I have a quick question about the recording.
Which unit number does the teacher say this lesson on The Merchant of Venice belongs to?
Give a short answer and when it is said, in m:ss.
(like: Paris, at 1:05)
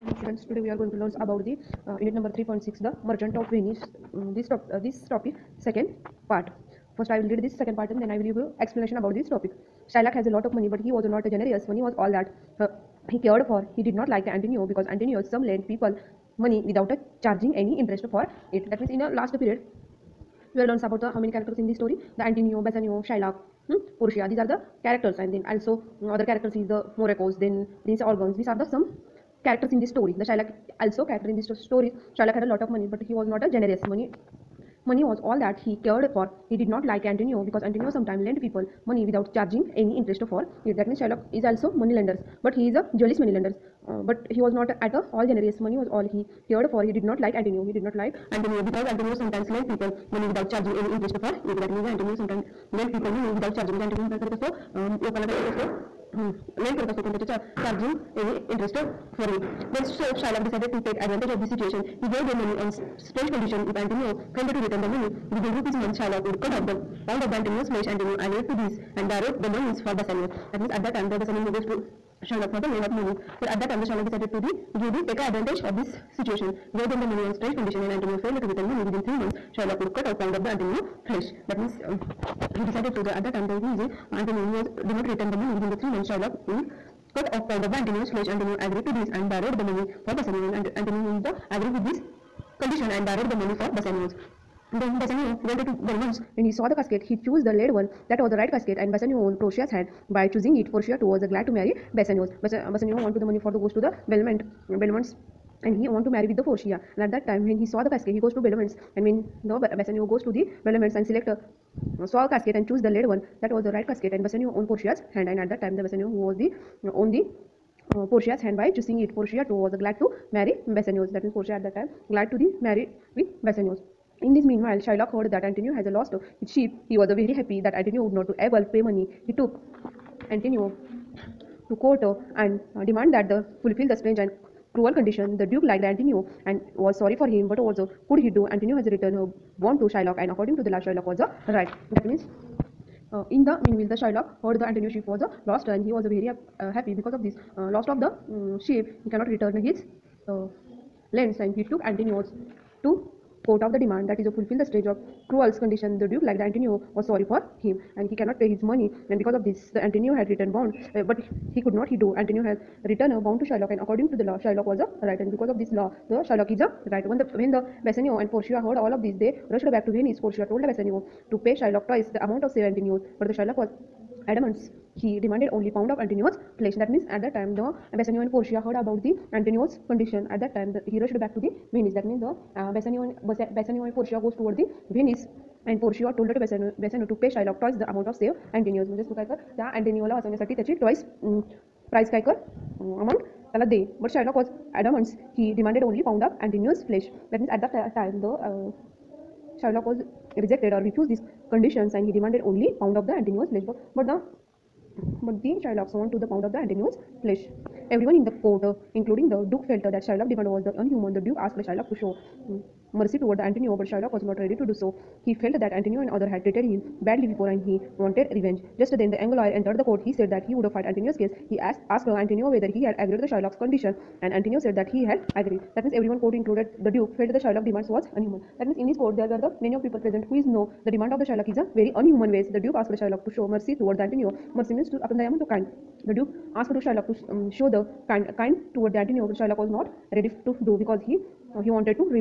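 3.6, at 0:02.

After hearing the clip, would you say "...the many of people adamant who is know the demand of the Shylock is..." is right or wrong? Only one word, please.
wrong.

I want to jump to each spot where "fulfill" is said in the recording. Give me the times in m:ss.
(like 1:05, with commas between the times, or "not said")
2:13, 2:34.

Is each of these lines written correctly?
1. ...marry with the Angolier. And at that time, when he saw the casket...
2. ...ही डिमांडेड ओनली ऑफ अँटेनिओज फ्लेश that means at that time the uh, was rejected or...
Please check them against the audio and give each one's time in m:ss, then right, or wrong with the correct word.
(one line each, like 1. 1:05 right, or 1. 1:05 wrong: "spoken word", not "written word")
1. 1:46 wrong: "Portia", not "Angolier"
2. 3:15 right.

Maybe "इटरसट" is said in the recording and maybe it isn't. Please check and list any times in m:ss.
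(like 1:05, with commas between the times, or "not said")
0:58.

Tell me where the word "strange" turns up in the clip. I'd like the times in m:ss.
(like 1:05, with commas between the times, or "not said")
1:03, 1:17, 2:13.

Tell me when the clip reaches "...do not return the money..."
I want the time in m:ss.
1:24.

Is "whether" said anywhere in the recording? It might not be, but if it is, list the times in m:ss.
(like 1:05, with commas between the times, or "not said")
3:42.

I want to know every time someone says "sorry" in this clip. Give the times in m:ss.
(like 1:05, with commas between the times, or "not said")
2:16, 2:37.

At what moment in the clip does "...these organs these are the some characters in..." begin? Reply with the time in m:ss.
0:27.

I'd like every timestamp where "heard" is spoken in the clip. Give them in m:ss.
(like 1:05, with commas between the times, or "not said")
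2:05, 2:24, 2:48, 2:58.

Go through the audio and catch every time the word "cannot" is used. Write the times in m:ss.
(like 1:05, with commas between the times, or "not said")
2:29, 2:38.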